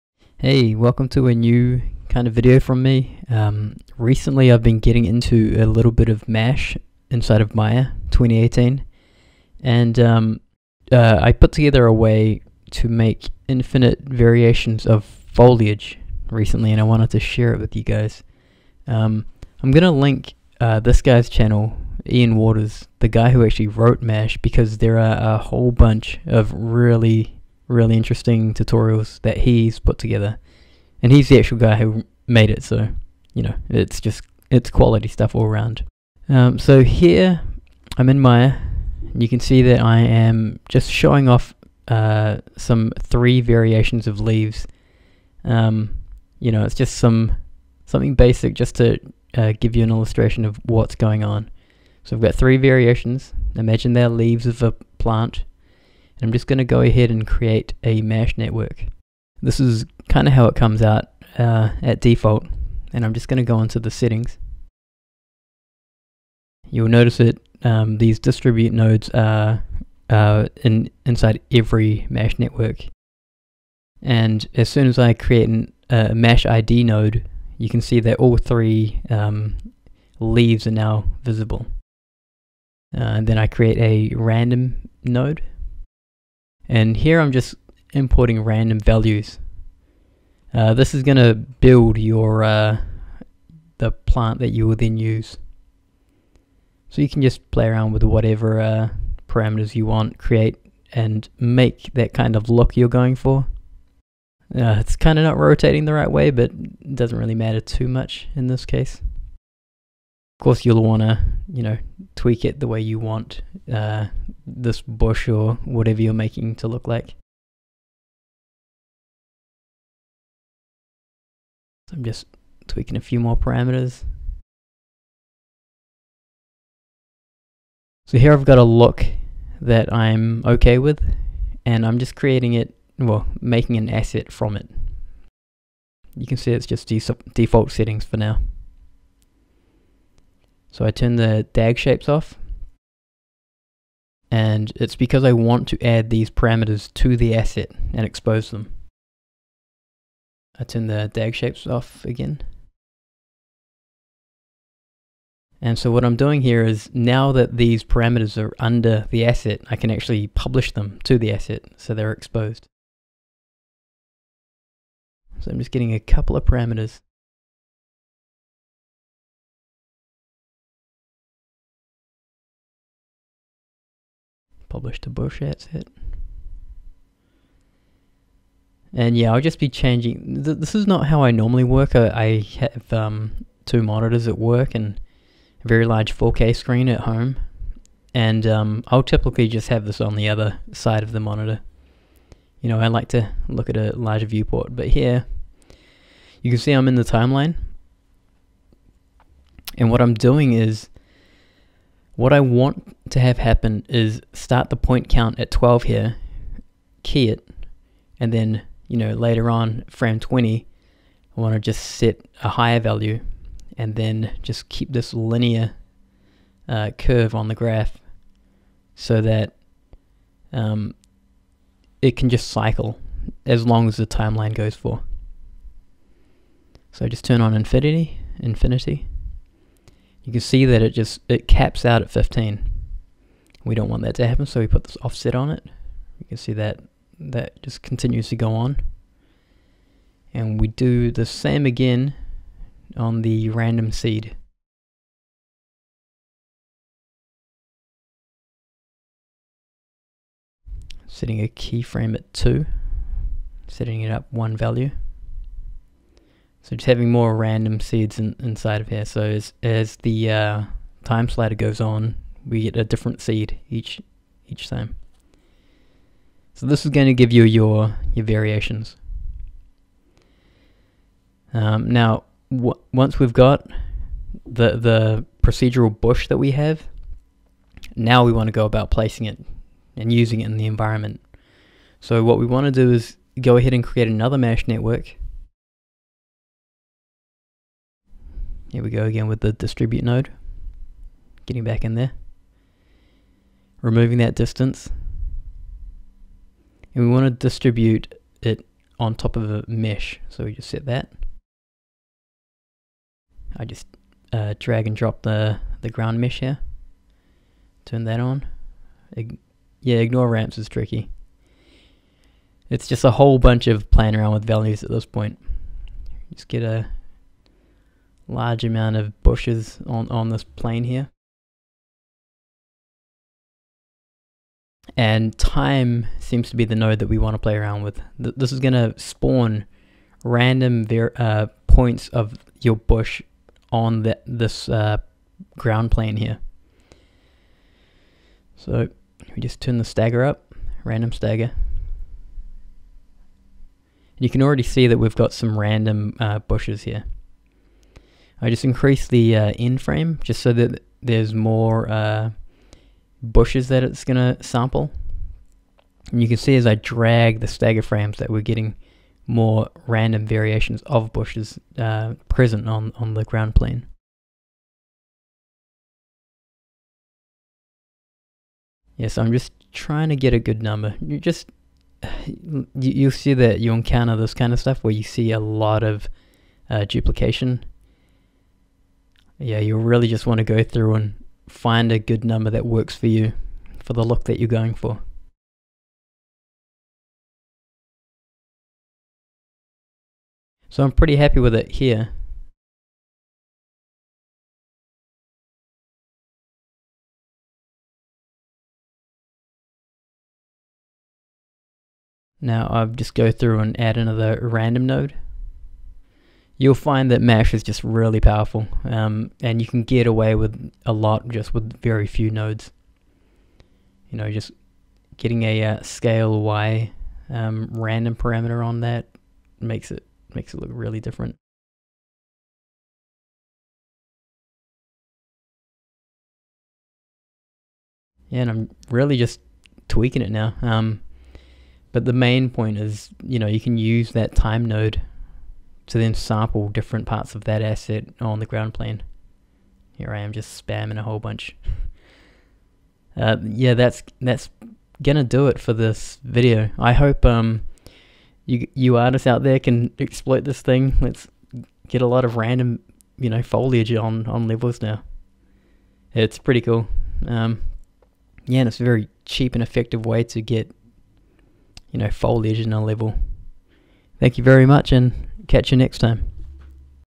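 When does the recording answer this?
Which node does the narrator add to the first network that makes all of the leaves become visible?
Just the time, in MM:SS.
01:16.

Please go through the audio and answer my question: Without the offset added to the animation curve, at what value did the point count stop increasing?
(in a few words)
15.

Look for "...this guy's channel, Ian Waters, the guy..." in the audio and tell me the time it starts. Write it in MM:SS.
00:20.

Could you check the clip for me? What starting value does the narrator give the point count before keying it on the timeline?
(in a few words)
12.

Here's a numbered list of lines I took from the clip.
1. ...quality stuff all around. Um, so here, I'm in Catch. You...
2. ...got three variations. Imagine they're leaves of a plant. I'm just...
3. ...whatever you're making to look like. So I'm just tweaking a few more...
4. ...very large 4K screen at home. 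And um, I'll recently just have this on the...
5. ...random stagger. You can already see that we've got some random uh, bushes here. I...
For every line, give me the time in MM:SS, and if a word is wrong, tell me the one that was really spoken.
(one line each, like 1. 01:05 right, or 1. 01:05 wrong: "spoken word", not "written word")
1. 00:34 wrong: "Maya", not "Catch"
2. 00:52 right
3. 01:55 right
4. 03:05 wrong: "typically", not "recently"
5. 05:40 right.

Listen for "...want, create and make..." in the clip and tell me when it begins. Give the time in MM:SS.
01:39.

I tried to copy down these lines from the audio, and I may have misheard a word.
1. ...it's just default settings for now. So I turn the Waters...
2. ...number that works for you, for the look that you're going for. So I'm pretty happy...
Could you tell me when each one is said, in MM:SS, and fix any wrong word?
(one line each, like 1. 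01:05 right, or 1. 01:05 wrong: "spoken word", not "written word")
1. 02:16 wrong: "DAG", not "Waters"
2. 06:22 right.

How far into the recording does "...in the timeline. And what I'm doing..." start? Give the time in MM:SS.
03:16.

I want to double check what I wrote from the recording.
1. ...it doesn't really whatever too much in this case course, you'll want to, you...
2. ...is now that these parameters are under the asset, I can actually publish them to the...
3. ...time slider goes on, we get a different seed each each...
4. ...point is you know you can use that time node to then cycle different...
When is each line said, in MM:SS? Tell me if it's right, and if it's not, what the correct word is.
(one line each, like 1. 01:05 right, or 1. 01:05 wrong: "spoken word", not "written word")
1. 01:46 wrong: "matter", not "whatever"
2. 02:36 right
3. 04:21 right
4. 07:12 wrong: "sample", not "cycle".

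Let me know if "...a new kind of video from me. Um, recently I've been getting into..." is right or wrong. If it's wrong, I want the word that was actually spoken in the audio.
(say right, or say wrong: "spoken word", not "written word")
right.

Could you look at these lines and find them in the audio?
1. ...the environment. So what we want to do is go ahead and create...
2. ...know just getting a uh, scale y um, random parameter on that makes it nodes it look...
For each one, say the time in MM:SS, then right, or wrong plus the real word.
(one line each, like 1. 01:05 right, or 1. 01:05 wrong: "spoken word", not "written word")
1. 04:40 right
2. 06:54 wrong: "makes", not "nodes".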